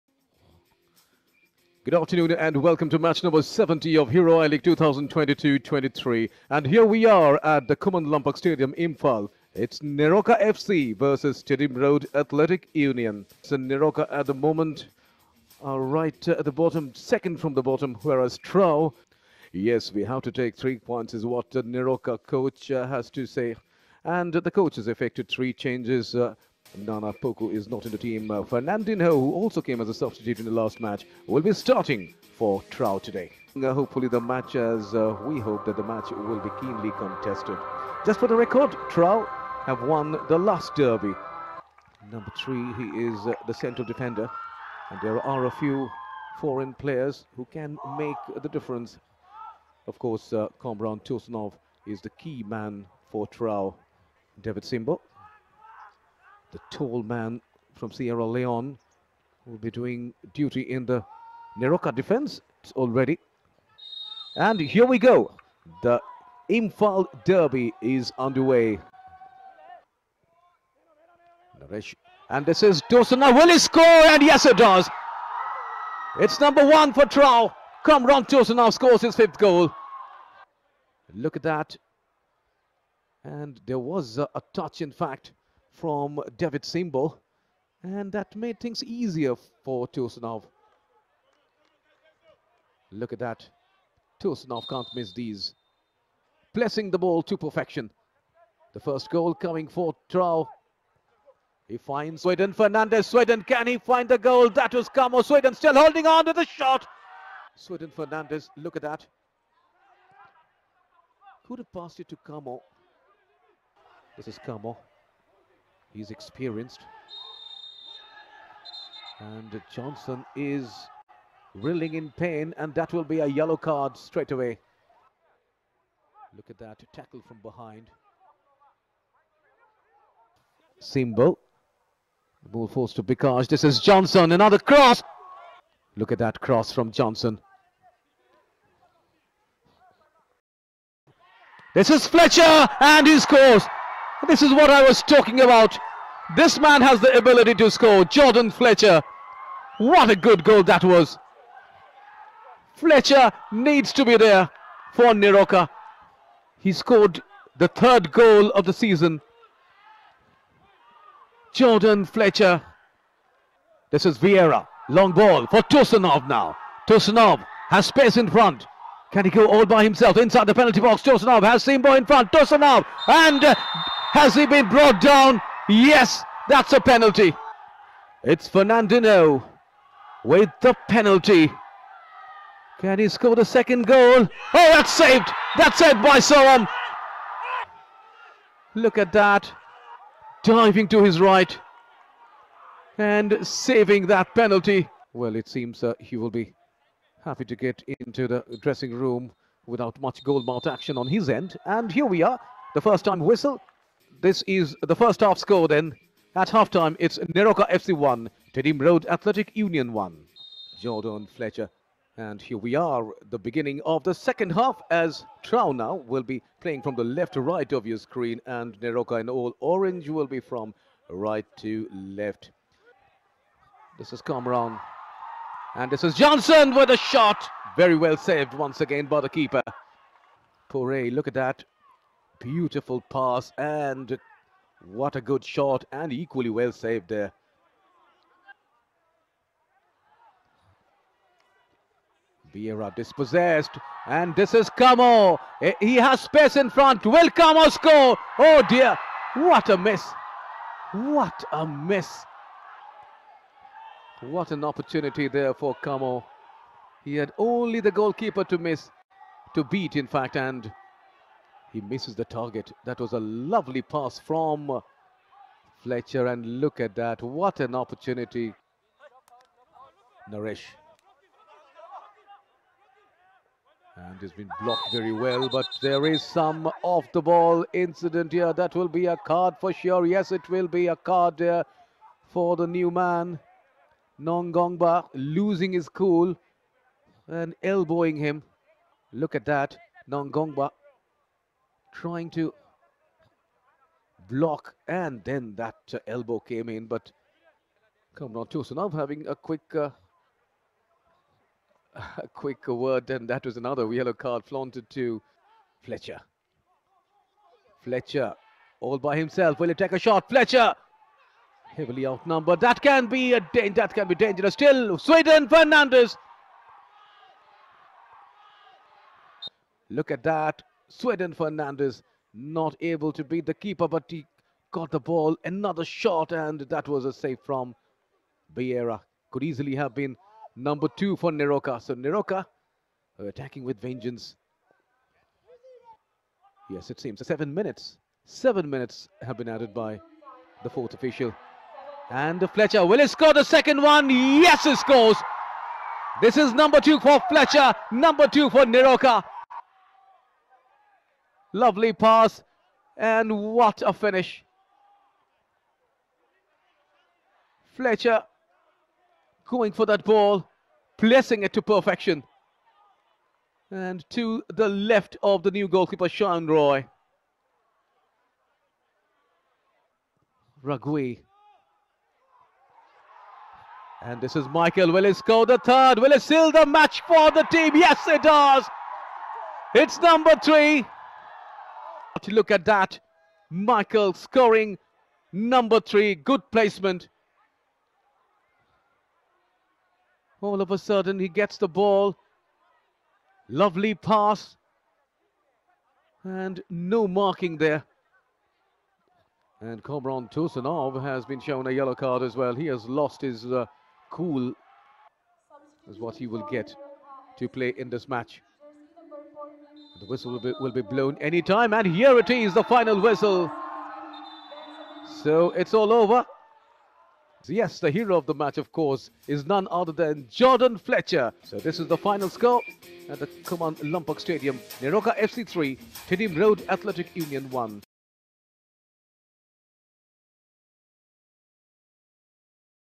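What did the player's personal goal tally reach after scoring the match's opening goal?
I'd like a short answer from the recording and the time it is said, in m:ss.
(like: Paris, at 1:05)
5, at 1:19.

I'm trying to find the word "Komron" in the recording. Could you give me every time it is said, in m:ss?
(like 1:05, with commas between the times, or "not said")
0:50, 6:39.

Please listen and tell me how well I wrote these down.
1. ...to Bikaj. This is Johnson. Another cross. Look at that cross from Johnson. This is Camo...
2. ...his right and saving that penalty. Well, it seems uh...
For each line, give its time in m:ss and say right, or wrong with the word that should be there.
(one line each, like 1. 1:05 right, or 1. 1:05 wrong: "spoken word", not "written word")
1. 2:12 wrong: "Fletcher", not "Camo"
2. 3:11 right.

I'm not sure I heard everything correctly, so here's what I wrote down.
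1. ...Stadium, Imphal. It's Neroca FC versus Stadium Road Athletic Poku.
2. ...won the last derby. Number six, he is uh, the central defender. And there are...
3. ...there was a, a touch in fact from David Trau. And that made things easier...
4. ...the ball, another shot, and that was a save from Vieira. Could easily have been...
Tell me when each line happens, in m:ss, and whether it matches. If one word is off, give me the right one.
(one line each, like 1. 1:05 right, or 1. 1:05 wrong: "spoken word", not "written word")
1. 0:08 wrong: "Union", not "Poku"
2. 0:39 wrong: "three", not "six"
3. 1:23 wrong: "Simbo", not "Trau"
4. 5:24 right.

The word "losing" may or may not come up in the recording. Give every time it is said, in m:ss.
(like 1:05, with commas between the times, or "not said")
4:45.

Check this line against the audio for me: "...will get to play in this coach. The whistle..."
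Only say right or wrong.
wrong.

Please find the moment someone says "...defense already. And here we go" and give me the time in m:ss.
1:01.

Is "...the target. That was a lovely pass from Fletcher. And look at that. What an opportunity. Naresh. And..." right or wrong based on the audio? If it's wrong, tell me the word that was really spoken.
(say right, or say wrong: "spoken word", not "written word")
right.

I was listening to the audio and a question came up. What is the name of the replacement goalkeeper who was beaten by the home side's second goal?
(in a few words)
Sean Roy.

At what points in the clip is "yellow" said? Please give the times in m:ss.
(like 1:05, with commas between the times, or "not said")
2:03, 5:03, 6:41.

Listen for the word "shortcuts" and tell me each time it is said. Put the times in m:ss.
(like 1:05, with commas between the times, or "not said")
not said.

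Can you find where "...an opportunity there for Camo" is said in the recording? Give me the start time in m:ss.
4:14.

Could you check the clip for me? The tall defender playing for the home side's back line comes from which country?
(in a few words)
Sierra Leone.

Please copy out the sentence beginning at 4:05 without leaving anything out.
Eh, he has space in front.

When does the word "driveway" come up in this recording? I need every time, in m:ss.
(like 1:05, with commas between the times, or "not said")
not said.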